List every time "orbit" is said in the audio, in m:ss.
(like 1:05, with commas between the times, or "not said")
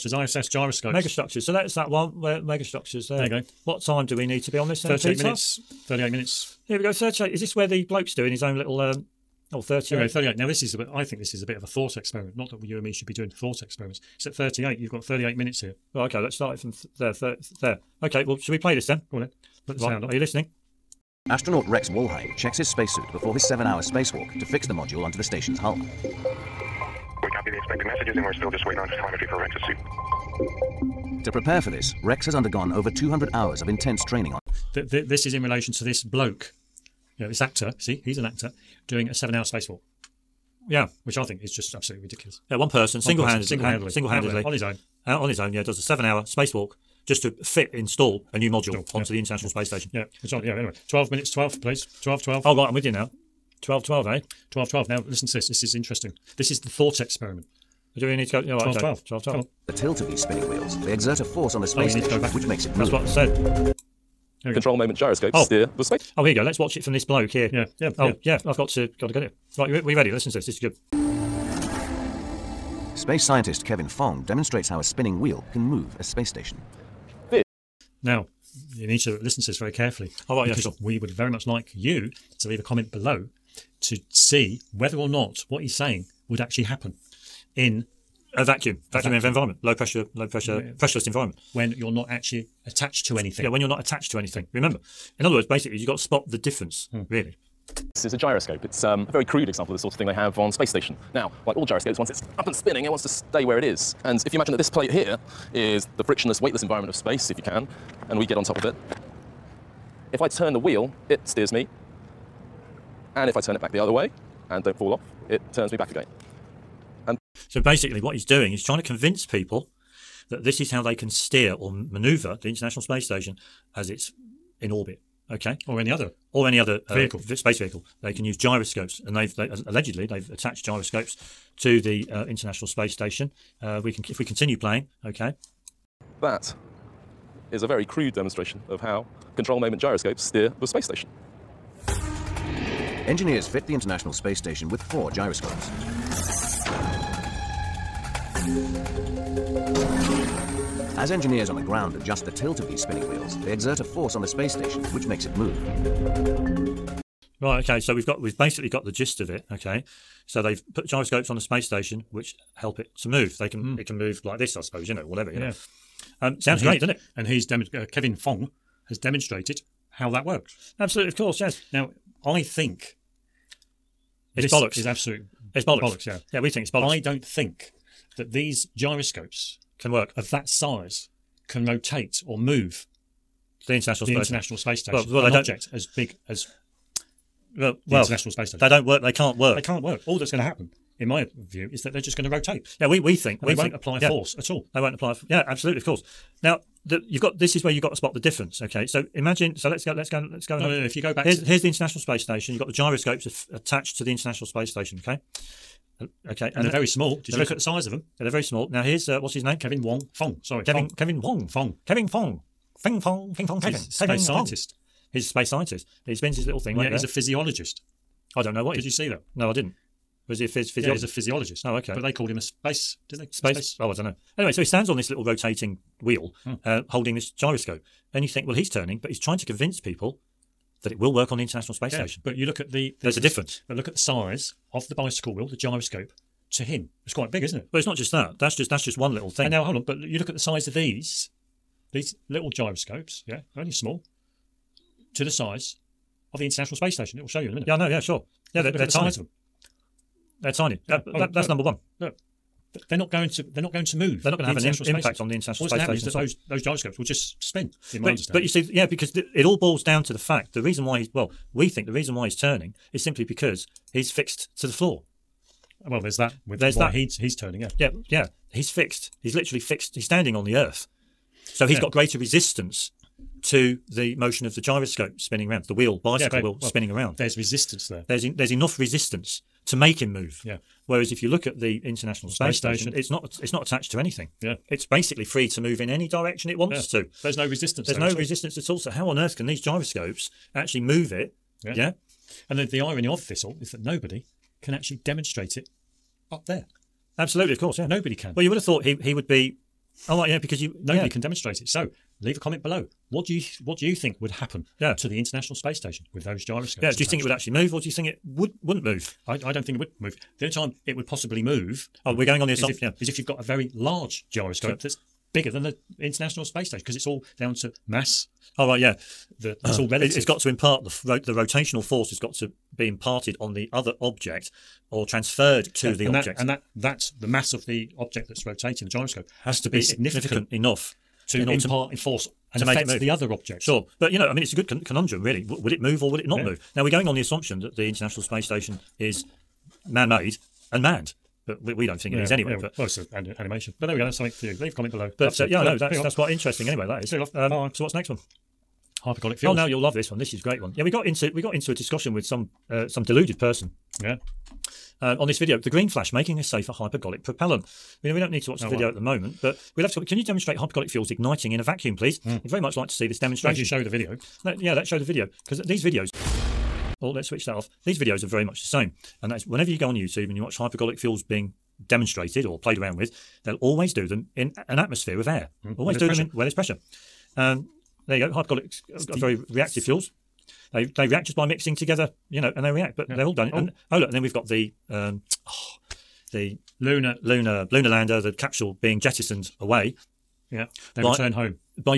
2:04.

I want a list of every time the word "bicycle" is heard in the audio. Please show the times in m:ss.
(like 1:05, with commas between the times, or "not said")
3:54, 4:36.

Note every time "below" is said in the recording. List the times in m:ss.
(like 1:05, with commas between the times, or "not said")
1:22, 5:02, 5:44.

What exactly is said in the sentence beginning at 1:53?
And if I turn it back the other way and don't fall off, it turns me back again.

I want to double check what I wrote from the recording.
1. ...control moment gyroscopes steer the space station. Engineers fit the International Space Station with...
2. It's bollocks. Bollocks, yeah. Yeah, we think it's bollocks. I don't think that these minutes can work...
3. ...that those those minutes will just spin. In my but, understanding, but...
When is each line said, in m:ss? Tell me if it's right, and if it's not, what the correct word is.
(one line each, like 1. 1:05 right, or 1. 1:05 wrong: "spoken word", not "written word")
1. 2:19 right
2. 2:55 wrong: "gyroscopes", not "minutes"
3. 4:16 wrong: "gyroscopes", not "minutes".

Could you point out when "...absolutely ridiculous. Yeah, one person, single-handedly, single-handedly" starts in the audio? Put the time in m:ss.
0:41.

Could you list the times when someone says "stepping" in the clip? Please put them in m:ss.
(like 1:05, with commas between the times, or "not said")
not said.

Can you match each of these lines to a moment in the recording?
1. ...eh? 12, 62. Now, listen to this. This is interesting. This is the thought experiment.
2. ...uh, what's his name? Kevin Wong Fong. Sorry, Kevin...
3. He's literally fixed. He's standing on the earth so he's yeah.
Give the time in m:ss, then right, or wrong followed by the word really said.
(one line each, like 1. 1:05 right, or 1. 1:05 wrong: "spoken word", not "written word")
1. 0:54 wrong: "12", not "62"
2. 3:29 right
3. 4:29 right.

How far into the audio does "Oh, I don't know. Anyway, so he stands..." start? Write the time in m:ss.
3:43.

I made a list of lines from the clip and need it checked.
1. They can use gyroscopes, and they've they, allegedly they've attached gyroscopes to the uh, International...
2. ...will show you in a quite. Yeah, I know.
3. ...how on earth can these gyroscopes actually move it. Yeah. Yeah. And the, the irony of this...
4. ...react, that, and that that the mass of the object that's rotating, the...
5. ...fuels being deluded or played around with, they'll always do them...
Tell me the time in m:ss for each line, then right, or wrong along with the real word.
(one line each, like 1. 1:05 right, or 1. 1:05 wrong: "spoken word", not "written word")
1. 2:08 right
2. 4:07 wrong: "minute", not "quite"
3. 4:48 right
4. 5:26 wrong: "object", not "react"
5. 6:10 wrong: "demonstrated", not "deluded".